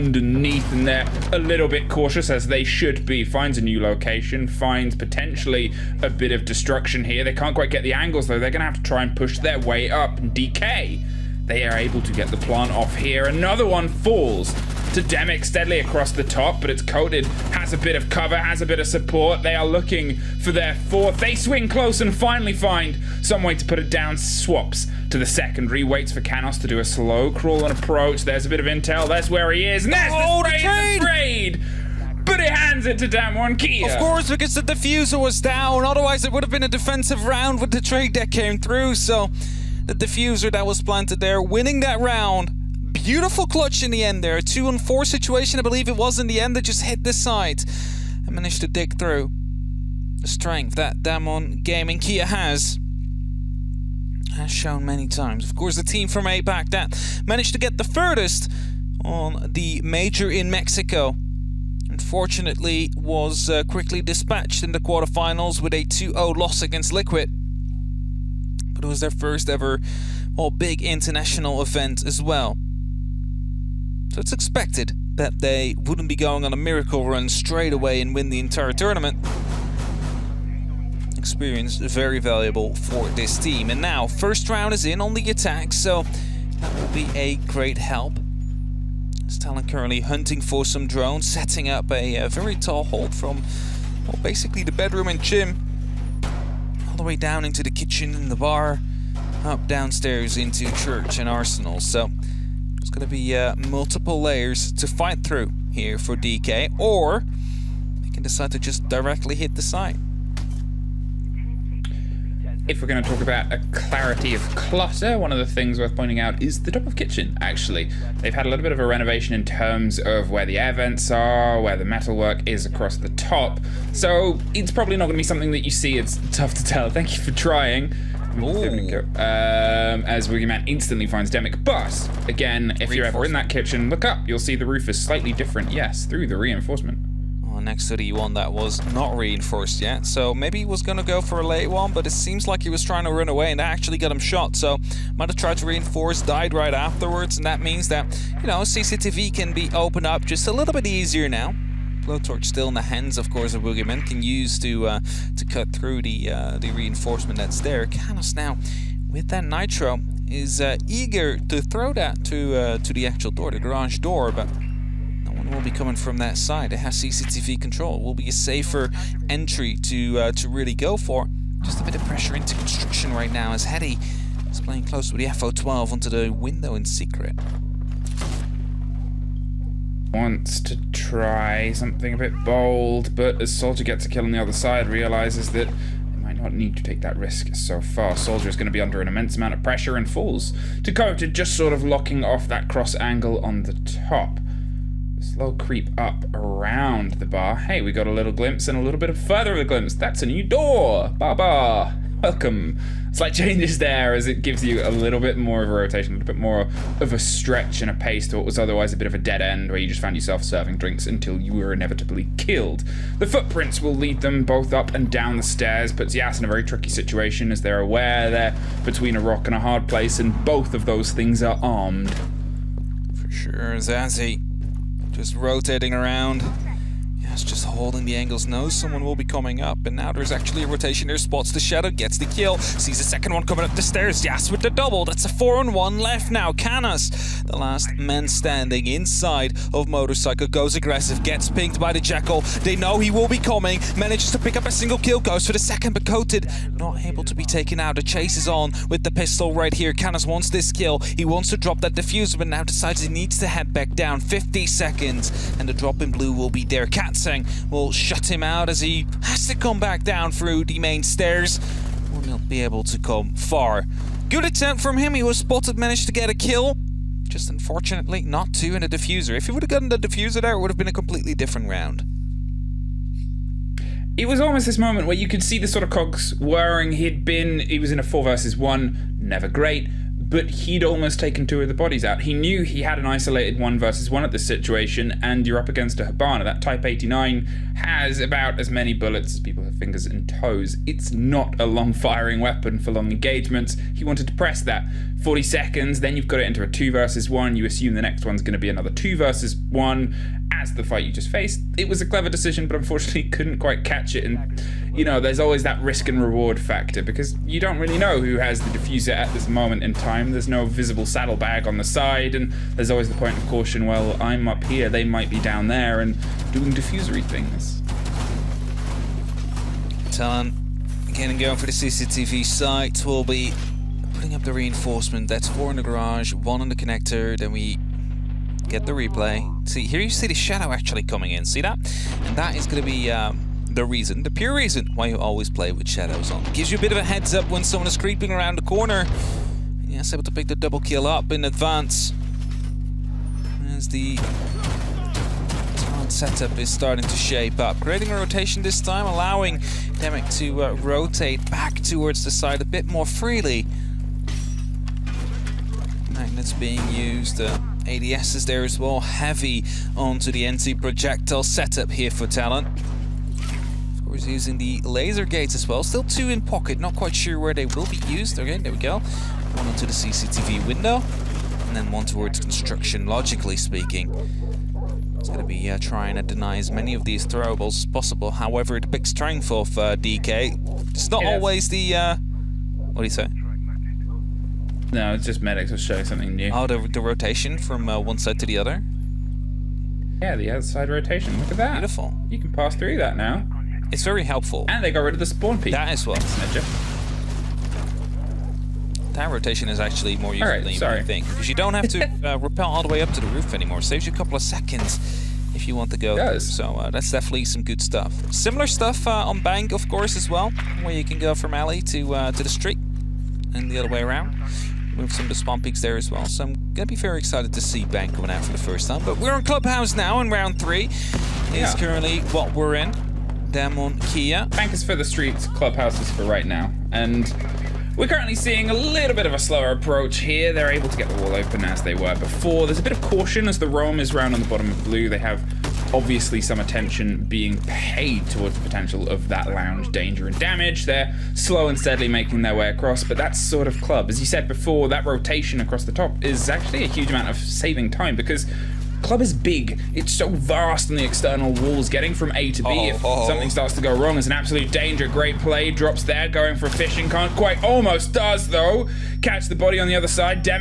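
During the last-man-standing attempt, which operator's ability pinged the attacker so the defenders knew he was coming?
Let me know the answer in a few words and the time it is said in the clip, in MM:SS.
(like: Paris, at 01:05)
Jackal, at 04:01.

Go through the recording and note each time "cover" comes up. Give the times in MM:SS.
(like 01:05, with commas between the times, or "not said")
00:18.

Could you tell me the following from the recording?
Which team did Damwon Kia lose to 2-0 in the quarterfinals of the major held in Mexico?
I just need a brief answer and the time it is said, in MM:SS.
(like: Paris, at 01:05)
Liquid, at 01:06.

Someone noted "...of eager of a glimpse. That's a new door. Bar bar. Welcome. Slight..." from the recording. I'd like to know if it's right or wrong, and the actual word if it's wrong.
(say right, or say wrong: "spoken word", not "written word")
wrong: "further", not "eager".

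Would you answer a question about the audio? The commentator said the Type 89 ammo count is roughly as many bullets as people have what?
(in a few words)
fingers and toes.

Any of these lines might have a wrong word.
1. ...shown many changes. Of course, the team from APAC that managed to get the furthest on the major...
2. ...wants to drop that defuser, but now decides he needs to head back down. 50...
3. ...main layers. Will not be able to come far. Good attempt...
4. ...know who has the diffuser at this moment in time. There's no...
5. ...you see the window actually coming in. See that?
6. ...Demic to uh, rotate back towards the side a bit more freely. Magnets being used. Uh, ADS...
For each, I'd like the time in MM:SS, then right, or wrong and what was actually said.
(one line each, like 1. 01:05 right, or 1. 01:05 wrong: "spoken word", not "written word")
1. 00:54 wrong: "times", not "changes"
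2. 04:11 right
3. 04:20 wrong: "stairs", not "layers"
4. 05:07 right
5. 05:29 wrong: "shadow", not "window"
6. 05:49 right.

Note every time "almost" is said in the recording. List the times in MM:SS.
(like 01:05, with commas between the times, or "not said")
04:34, 04:40, 07:37.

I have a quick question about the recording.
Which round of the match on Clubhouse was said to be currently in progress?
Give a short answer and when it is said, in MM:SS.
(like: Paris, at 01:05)
3, at 07:00.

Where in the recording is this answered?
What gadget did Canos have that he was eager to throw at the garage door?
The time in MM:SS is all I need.
02:39.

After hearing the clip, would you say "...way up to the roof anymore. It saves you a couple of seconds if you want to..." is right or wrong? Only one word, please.
right.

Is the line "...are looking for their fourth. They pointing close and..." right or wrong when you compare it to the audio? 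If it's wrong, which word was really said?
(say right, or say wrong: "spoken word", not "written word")
wrong: "swing", not "pointing".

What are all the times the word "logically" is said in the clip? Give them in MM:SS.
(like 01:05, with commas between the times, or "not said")
06:13.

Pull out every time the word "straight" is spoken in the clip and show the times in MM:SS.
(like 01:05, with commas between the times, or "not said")
01:17.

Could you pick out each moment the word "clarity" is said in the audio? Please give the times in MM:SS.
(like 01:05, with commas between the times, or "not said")
01:53.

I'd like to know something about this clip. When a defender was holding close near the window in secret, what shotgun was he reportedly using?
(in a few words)
FO12.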